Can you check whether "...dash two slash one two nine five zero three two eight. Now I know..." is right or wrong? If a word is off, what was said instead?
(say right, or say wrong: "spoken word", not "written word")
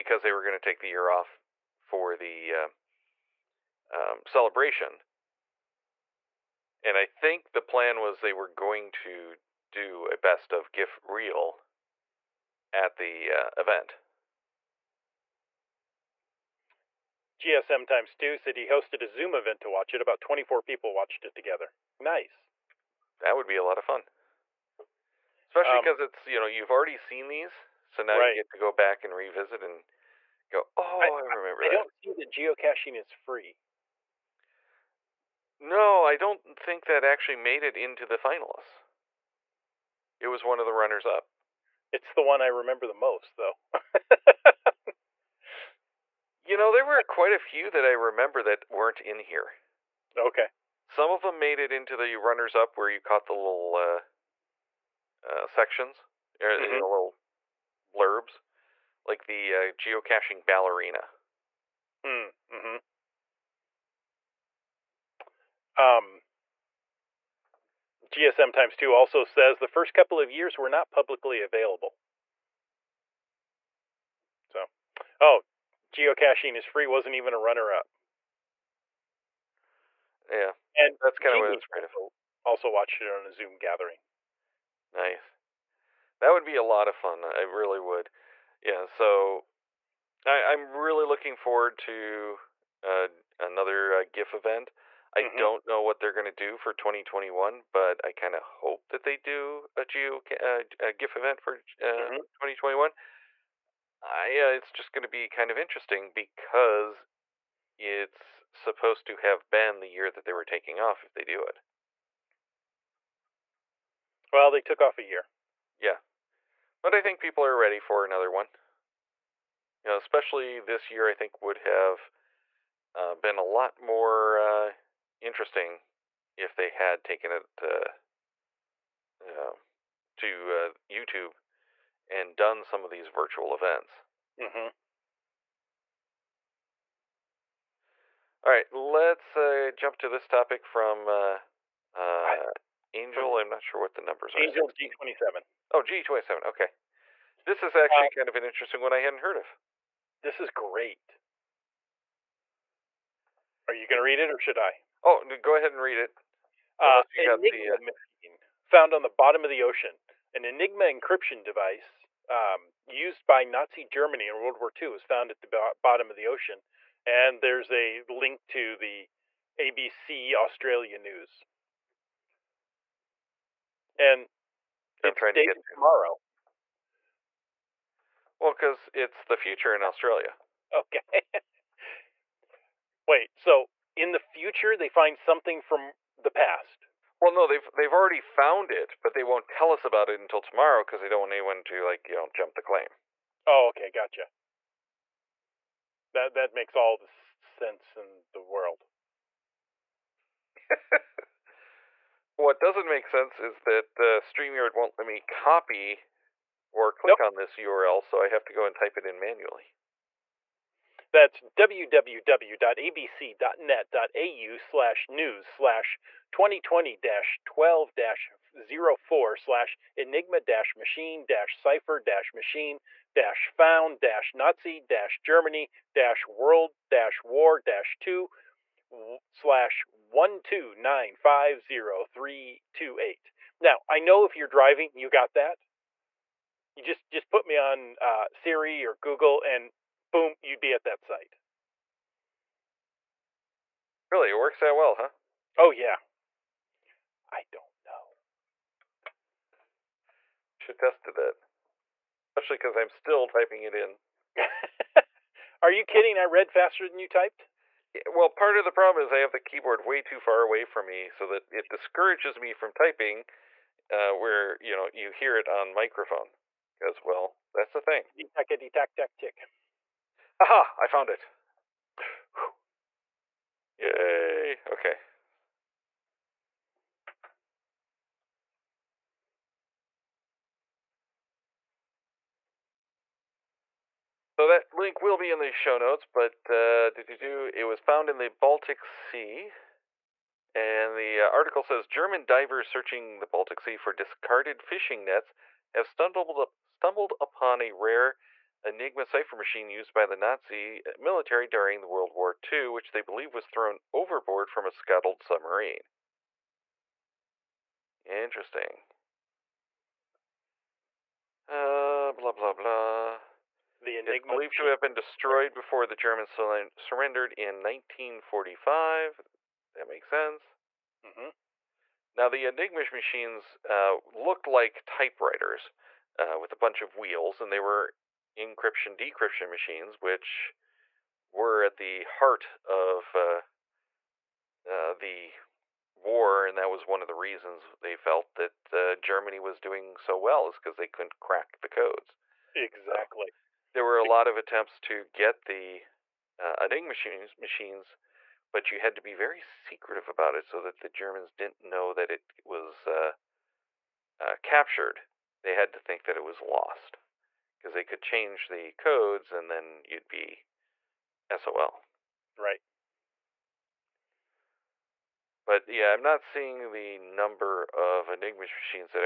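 right.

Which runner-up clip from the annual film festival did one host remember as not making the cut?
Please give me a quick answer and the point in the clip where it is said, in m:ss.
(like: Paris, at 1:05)
geocaching ballerina, at 0:59.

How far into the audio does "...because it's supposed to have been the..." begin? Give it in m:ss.
1:46.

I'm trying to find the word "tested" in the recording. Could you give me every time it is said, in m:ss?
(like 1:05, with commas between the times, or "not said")
4:10.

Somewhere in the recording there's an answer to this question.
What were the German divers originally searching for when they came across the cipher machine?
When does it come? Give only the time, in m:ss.
4:53.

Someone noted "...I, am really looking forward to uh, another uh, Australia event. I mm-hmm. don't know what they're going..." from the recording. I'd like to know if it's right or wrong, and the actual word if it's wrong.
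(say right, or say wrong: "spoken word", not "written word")
wrong: "GIF", not "Australia".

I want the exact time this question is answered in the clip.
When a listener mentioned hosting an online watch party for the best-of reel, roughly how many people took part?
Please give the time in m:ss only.
0:20.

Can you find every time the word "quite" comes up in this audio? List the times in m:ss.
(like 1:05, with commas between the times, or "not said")
0:47.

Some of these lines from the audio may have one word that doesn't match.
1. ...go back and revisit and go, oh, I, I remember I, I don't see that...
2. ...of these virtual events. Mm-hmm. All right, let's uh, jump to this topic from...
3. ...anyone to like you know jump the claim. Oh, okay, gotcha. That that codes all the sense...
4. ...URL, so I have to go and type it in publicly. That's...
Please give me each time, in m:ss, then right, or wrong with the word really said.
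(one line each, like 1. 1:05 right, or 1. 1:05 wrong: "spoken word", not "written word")
1. 0:28 right
2. 2:12 right
3. 3:11 wrong: "makes", not "codes"
4. 3:27 wrong: "manually", not "publicly".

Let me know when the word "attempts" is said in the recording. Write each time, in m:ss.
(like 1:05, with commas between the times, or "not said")
5:44.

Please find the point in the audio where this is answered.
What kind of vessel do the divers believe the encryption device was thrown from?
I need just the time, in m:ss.
5:04.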